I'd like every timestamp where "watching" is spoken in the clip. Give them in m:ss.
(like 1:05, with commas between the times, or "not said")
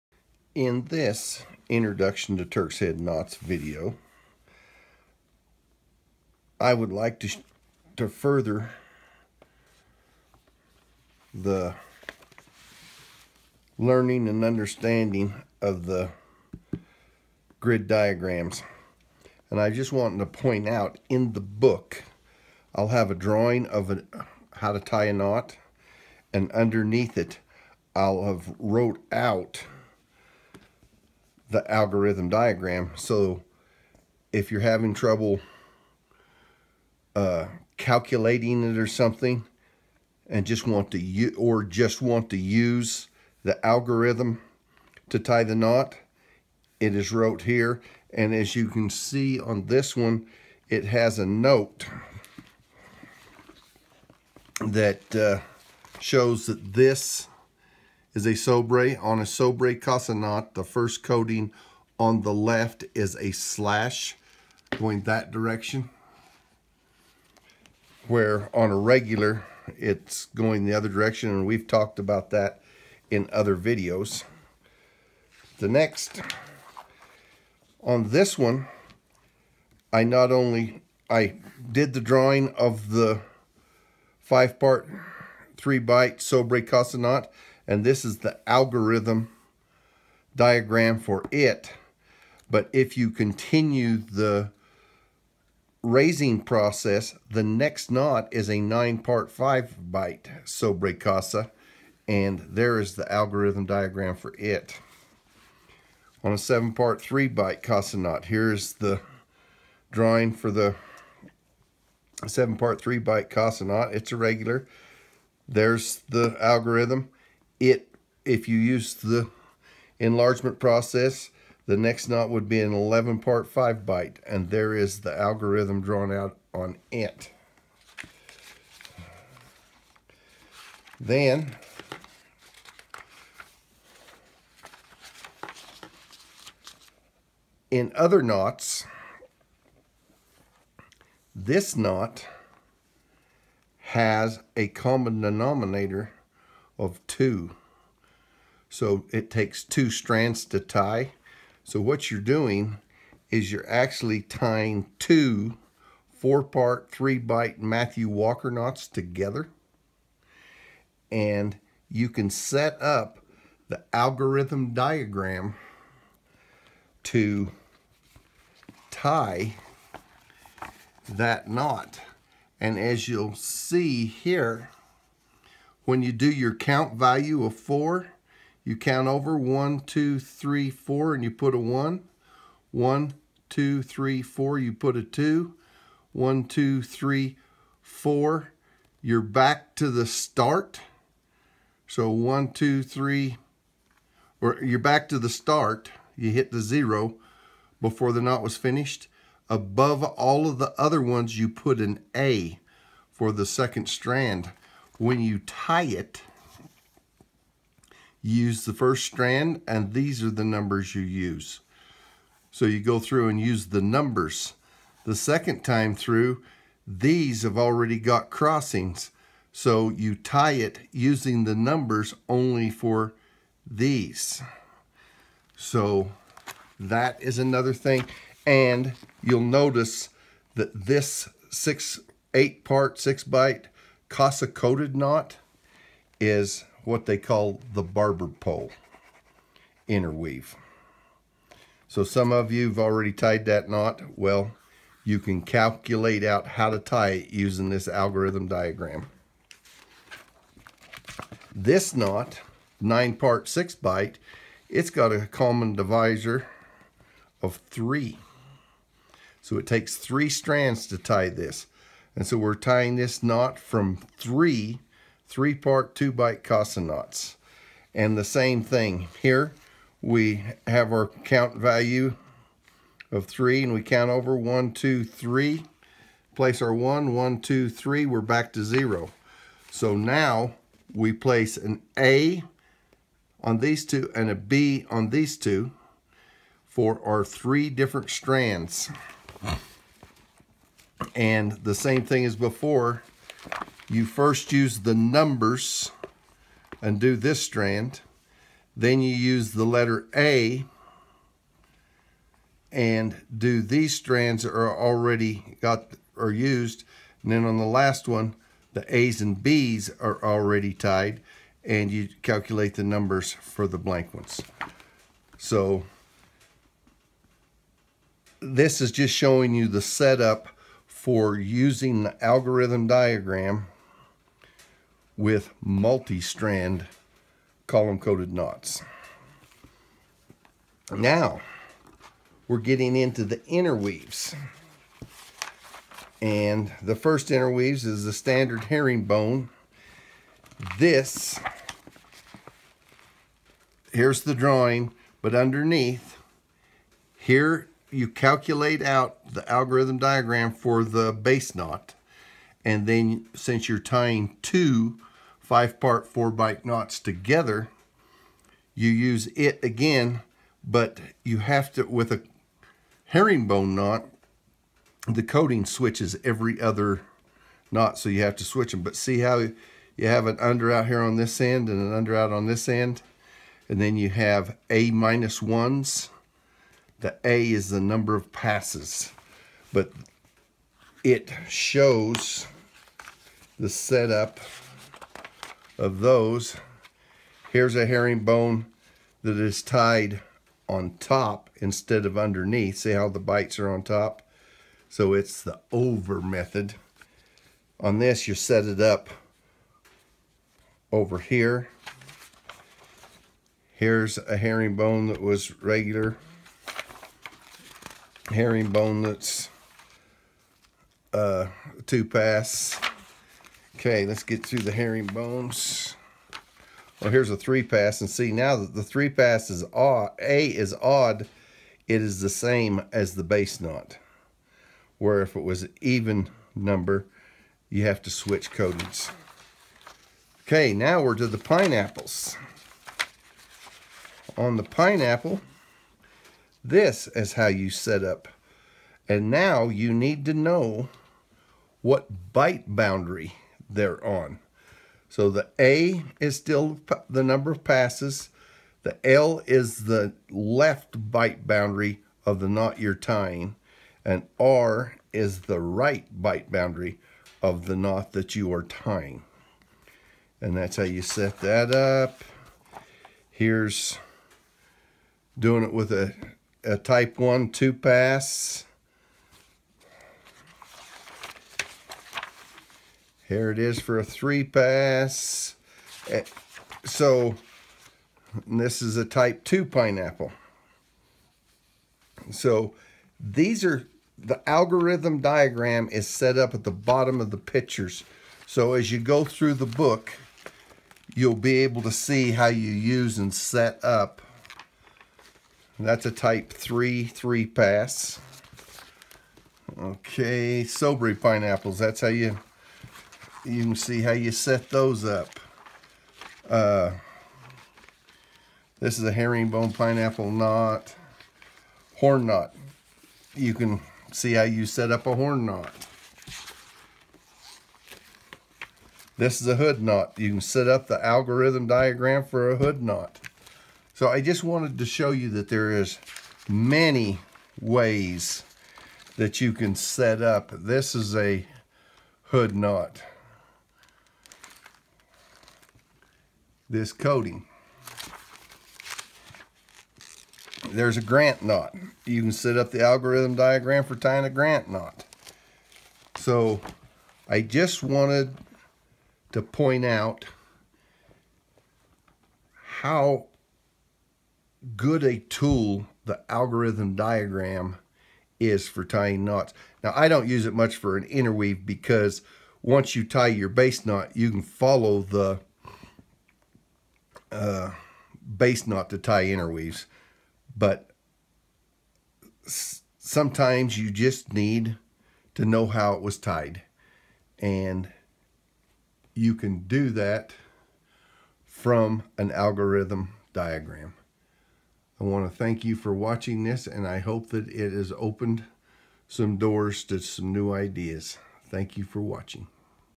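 9:45, 9:52.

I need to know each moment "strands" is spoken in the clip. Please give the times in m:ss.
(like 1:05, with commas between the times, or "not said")
2:29, 3:23, 3:29, 4:20, 4:48, 4:57, 5:03, 5:25.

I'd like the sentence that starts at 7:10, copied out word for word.
Okay, now we're to the pineapples.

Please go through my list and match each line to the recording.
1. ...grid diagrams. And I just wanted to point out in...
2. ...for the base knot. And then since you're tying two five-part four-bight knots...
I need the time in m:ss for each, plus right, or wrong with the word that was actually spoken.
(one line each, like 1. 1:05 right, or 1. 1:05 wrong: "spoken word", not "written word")
1. 0:17 right
2. 5:50 right.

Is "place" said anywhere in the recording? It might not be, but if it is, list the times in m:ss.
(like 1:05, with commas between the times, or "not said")
4:36, 4:41.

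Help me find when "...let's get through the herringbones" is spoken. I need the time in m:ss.
6:54.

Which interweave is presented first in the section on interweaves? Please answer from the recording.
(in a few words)
standard herringbone.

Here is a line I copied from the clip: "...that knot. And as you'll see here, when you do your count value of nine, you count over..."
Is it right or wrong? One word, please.
wrong.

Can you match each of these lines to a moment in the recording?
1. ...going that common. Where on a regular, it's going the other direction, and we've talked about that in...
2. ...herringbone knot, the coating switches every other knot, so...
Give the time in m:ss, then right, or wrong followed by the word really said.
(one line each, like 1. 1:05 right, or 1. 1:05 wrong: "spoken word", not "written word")
1. 1:04 wrong: "direction", not "common"
2. 6:03 right.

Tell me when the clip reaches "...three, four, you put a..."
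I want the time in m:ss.
3:03.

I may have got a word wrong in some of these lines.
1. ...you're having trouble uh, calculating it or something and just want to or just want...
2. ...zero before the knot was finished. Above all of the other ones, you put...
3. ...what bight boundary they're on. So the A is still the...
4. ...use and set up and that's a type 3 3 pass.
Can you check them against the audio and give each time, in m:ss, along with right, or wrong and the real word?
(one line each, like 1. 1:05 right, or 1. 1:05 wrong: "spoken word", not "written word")
1. 0:34 right
2. 3:16 right
3. 7:21 right
4. 8:12 right.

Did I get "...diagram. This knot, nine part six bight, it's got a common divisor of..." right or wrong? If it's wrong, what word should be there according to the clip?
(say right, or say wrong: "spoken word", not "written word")
right.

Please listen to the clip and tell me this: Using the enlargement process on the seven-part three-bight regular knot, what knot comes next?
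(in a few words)
11 part 5 bight.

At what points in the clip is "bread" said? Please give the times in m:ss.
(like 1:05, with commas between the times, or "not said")
not said.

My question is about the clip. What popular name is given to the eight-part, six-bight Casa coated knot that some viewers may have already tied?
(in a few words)
barber pole interweave.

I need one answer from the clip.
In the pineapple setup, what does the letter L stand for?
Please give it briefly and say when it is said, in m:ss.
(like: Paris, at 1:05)
left bight boundary, at 7:30.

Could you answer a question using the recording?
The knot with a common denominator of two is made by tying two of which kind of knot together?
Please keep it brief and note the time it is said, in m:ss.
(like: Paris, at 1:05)
four-part, three-bight Matthew Walker knots, at 2:36.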